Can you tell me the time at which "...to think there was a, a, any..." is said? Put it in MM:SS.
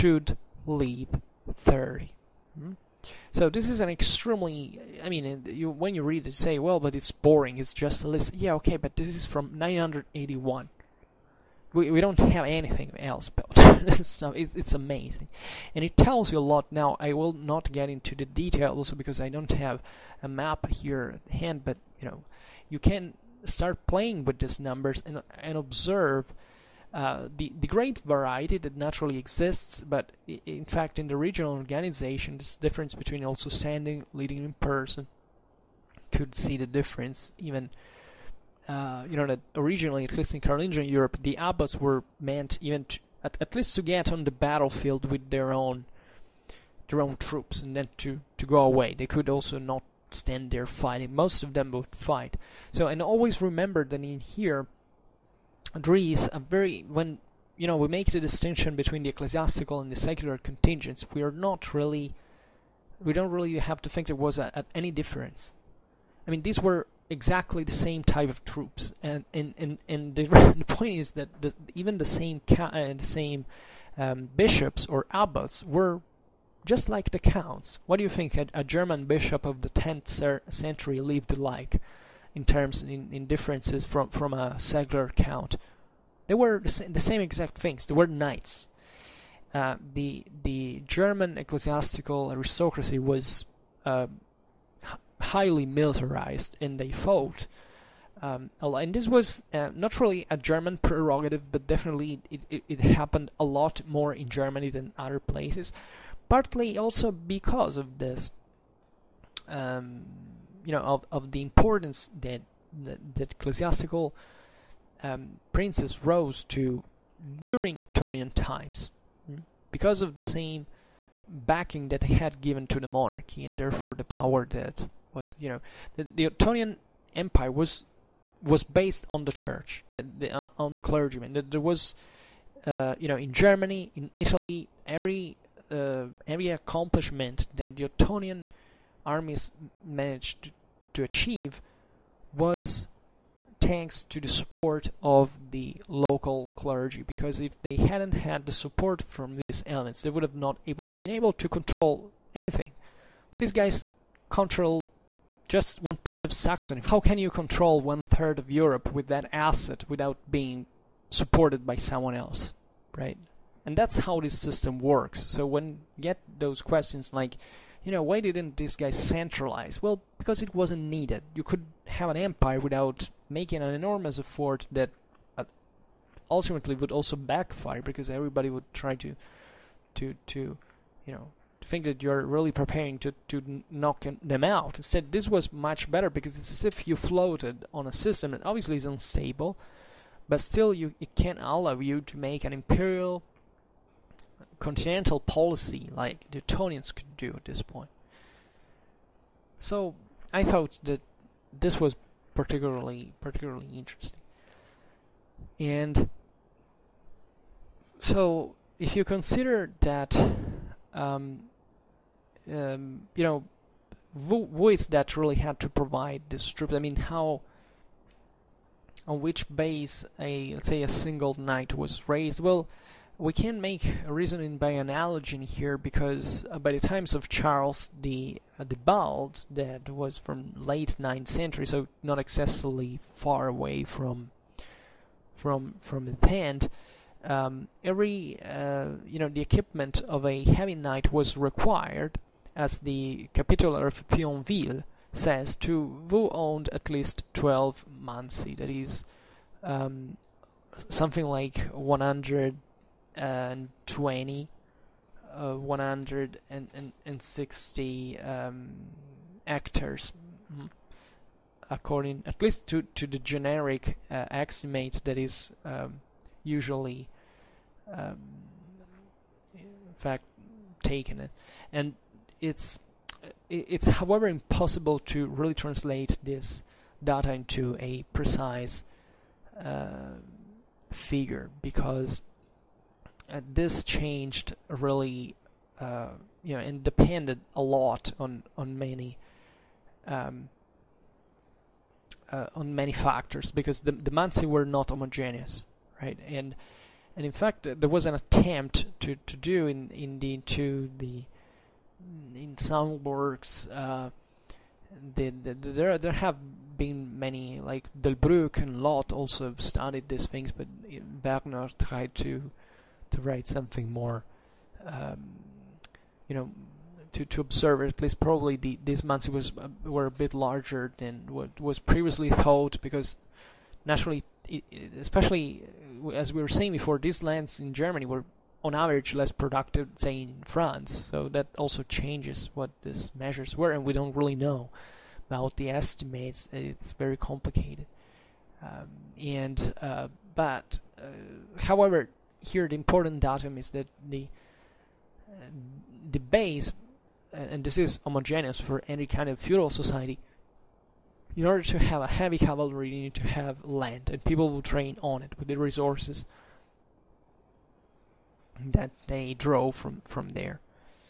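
01:03.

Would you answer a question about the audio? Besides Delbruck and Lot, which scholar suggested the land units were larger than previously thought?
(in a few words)
Wagner.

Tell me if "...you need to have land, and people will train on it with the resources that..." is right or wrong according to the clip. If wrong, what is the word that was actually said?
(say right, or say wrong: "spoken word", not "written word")
right.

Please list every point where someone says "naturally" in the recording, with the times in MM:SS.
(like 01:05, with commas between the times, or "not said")
00:28, 05:23.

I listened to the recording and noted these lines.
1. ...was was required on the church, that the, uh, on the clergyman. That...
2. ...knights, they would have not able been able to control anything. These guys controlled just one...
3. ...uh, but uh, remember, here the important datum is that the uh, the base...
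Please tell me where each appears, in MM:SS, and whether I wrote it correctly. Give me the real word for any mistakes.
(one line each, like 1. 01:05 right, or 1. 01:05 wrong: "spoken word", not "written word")
1. 02:07 wrong: "based", not "required"
2. 02:29 wrong: "elements", not "knights"
3. 05:39 wrong: "however", not "remember".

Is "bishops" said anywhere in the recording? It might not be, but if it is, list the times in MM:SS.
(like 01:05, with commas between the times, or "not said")
01:14, 01:19.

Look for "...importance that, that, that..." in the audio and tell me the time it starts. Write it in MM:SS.
01:51.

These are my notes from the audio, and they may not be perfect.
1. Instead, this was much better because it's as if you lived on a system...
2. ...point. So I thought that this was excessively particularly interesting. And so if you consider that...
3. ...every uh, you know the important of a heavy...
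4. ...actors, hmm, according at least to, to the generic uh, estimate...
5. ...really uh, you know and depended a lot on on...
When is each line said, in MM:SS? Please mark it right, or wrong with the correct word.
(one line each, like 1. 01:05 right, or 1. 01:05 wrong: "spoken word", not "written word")
1. 03:04 wrong: "floated", not "lived"
2. 03:17 wrong: "particularly", not "excessively"
3. 03:57 wrong: "equipment", not "important"
4. 04:19 right
5. 04:44 right.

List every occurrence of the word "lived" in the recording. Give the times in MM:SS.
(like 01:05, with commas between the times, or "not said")
01:21.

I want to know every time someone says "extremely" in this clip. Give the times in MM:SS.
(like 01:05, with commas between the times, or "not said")
00:03.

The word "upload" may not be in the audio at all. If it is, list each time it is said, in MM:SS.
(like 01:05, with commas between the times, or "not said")
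not said.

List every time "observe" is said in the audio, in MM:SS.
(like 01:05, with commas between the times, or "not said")
00:25, 05:17.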